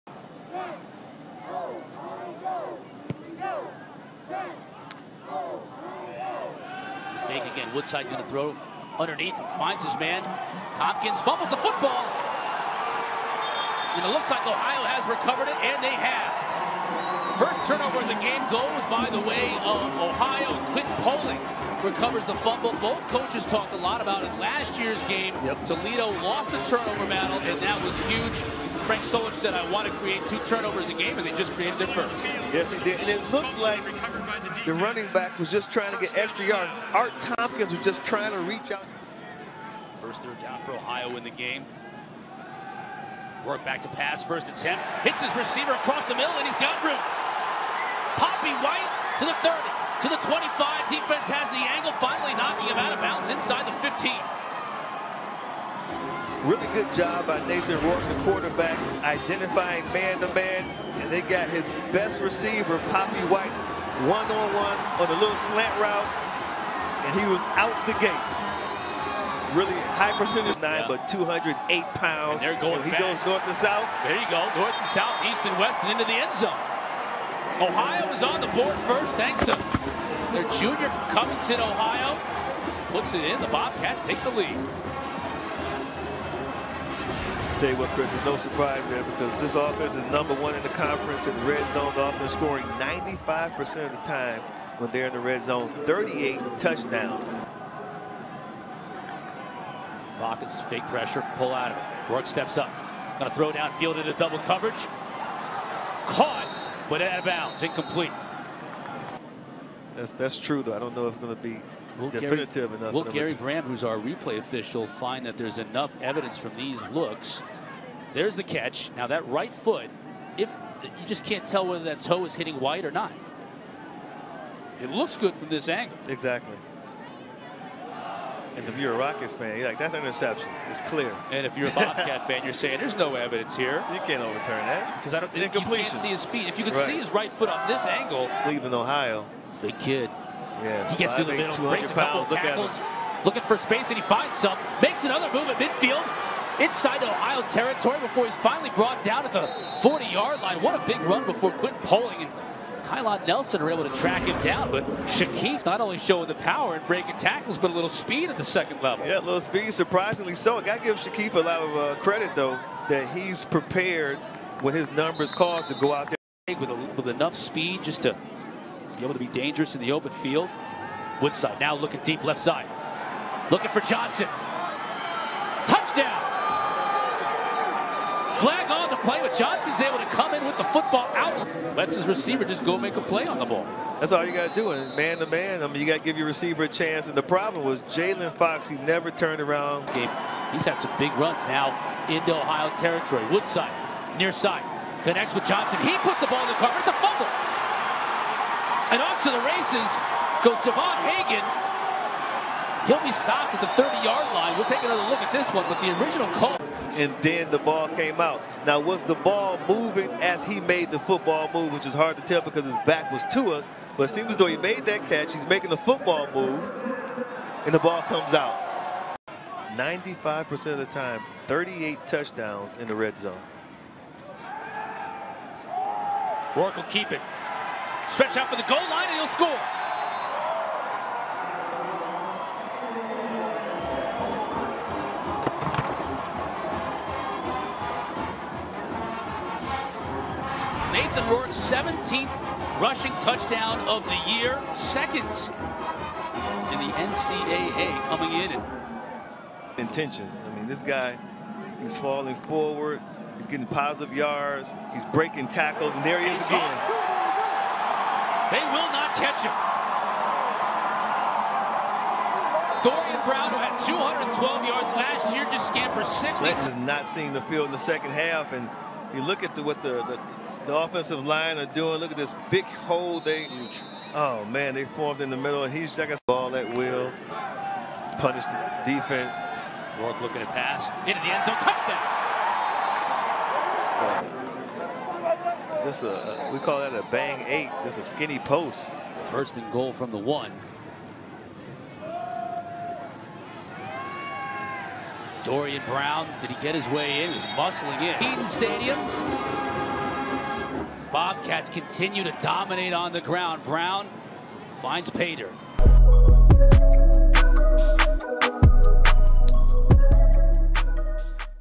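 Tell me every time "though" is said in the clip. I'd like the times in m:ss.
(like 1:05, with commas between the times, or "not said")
1:50, 2:42, 3:34.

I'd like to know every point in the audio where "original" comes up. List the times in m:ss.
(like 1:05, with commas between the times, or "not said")
3:26.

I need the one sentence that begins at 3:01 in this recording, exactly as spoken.
Lets his receiver just go make a play on the ball.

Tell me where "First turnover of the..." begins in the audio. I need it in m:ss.
0:17.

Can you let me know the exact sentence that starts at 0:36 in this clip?
Art Thompkins was just trying to reach out.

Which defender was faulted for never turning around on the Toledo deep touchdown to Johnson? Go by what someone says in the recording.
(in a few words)
Jalen Fox.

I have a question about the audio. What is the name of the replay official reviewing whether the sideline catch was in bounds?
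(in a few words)
Gary Bram.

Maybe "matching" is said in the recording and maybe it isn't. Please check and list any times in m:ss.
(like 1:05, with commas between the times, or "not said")
not said.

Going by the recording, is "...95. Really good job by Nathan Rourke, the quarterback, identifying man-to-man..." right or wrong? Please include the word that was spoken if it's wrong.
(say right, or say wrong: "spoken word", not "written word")
wrong: "15", not "95".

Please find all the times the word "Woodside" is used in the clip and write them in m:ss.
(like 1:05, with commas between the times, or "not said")
0:07, 2:51, 3:13.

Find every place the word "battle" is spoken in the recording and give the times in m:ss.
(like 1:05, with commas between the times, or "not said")
0:27.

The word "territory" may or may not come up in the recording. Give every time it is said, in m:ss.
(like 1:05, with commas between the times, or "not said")
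2:27, 3:12.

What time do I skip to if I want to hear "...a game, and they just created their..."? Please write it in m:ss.
0:30.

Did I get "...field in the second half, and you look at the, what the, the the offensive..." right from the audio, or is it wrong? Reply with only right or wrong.
right.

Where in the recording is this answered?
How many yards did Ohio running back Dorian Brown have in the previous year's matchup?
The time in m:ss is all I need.
4:23.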